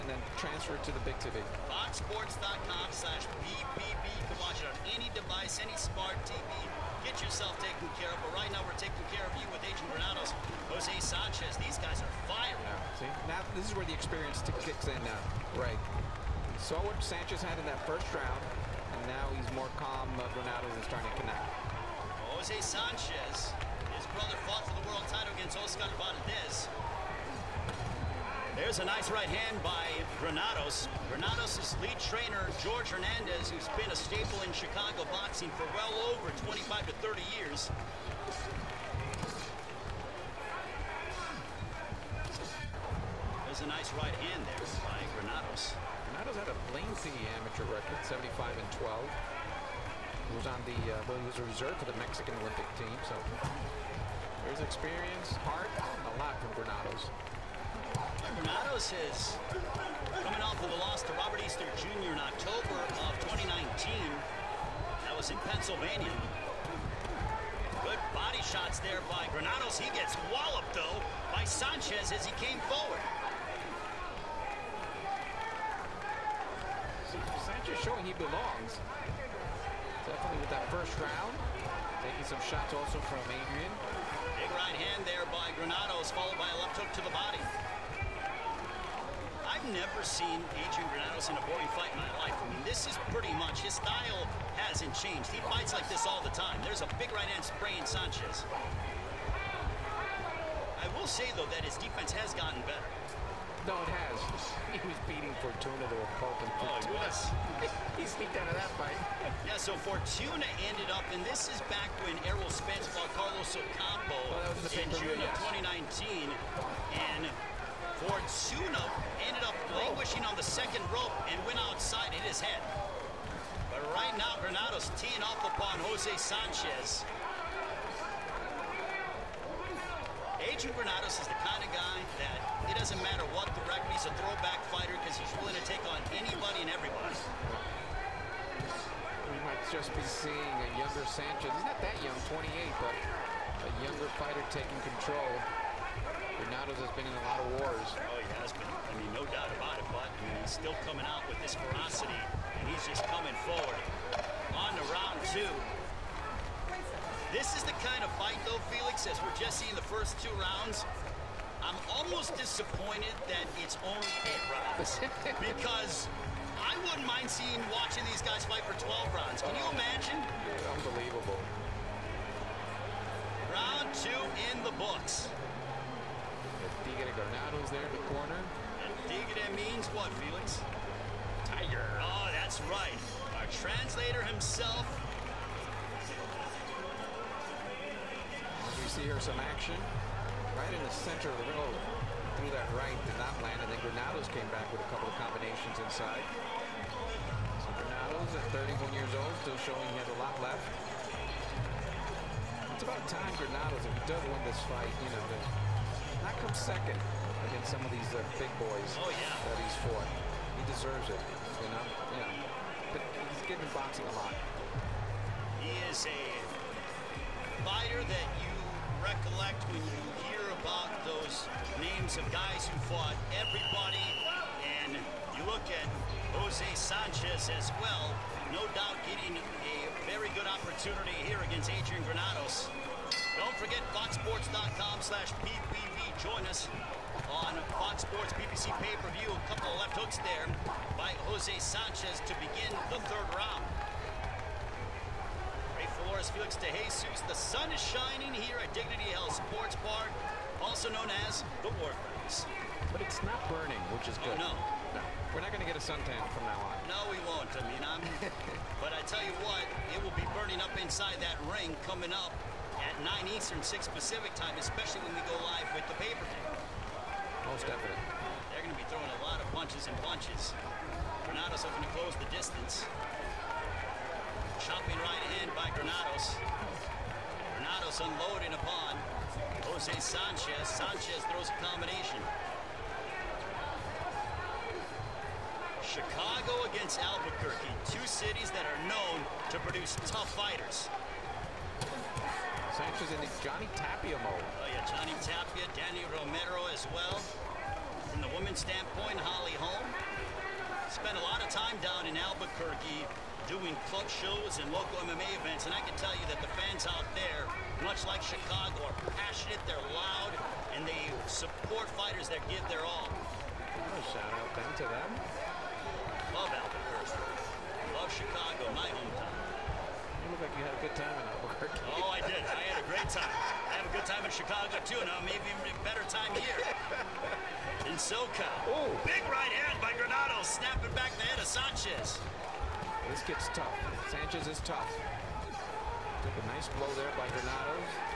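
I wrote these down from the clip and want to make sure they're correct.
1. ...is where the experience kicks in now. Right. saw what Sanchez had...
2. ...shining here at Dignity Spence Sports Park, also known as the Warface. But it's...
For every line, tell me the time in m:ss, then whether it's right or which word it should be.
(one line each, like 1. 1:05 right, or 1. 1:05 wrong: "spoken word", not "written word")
1. 0:13 right
2. 4:07 wrong: "Health", not "Spence".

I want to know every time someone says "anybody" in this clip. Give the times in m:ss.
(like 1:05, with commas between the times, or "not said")
2:16.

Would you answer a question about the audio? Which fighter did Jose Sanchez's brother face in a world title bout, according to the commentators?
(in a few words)
Oscar Valdez.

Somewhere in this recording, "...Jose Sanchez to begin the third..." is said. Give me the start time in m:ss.
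4:01.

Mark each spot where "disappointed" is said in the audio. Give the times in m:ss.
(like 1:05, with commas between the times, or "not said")
2:42.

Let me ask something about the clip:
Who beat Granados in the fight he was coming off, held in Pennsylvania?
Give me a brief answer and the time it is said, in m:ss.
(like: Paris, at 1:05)
Robert Easter Jr., at 1:01.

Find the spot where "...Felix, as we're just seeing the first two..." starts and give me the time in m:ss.
2:38.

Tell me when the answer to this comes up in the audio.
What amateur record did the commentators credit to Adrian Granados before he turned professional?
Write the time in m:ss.
0:48.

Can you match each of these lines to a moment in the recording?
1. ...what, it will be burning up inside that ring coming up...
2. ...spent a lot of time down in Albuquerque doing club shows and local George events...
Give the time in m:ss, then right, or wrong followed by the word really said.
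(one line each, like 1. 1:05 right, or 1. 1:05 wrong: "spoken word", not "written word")
1. 4:19 right
2. 5:00 wrong: "MMA", not "George".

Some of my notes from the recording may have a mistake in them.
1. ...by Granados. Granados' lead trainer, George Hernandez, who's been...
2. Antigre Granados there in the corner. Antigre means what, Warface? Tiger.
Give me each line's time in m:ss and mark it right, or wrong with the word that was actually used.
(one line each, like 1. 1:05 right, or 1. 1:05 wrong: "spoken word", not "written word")
1. 0:29 right
2. 2:56 wrong: "Felix", not "Warface".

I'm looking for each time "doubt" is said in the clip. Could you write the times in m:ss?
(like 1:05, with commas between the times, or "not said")
2:29, 3:48.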